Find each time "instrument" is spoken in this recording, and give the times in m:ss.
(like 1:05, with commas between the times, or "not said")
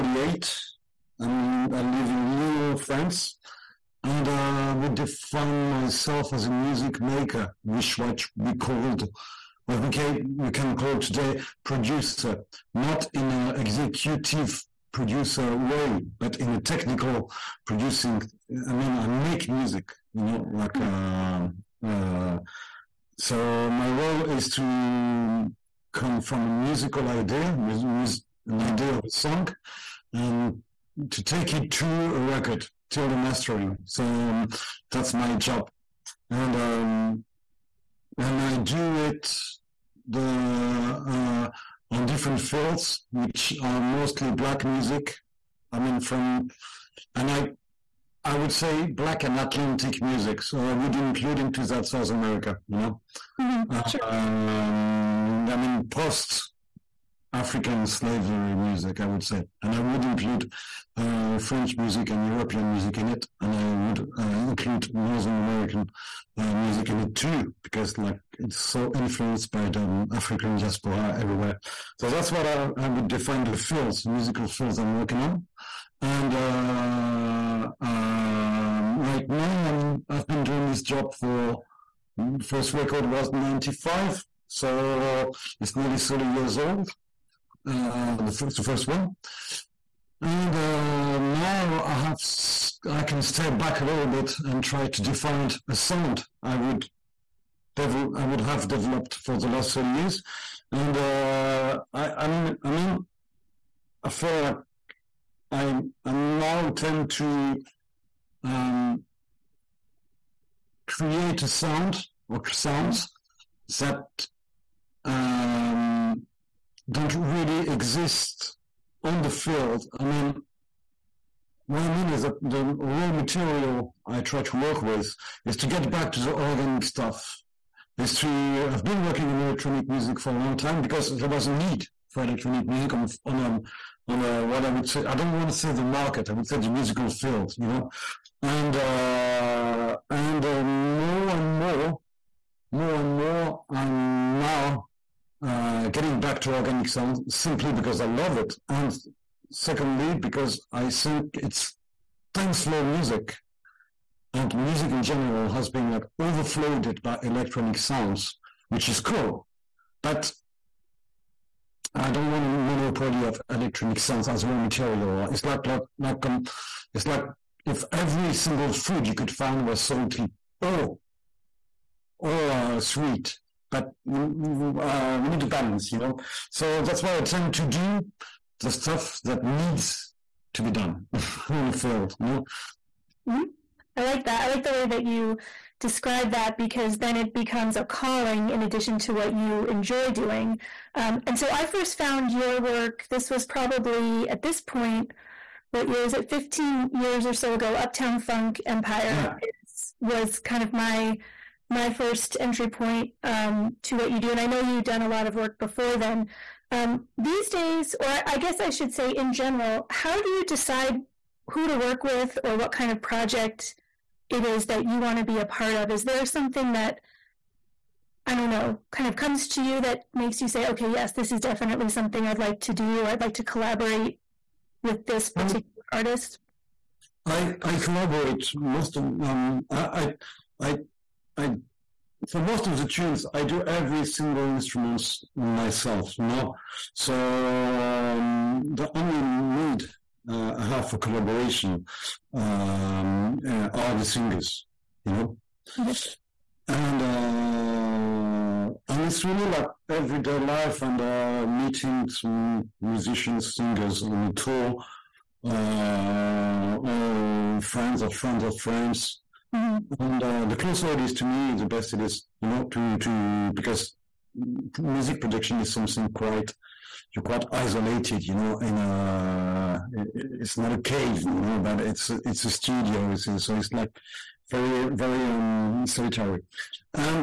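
3:54.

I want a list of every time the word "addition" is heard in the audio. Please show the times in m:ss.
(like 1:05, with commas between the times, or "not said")
3:08.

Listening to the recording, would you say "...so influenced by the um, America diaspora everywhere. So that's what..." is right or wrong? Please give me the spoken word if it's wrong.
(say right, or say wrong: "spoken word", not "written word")
wrong: "African", not "America".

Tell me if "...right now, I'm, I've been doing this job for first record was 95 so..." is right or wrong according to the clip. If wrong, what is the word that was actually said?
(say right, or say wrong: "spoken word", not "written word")
right.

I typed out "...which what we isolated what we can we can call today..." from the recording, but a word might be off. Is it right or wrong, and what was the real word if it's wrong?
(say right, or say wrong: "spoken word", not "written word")
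wrong: "called", not "isolated".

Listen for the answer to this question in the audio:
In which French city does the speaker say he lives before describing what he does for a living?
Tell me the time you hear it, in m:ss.
0:02.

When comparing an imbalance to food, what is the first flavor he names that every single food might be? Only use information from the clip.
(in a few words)
Salty.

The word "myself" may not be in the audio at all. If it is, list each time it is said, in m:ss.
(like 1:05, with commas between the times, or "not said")
0:05, 3:55.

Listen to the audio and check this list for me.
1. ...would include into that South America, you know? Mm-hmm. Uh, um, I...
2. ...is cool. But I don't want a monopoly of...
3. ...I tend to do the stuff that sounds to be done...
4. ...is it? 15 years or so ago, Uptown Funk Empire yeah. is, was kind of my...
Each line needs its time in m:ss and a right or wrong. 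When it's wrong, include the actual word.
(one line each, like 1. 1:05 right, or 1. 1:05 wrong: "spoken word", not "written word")
1. 0:50 right
2. 2:38 right
3. 2:57 wrong: "needs", not "sounds"
4. 3:16 right.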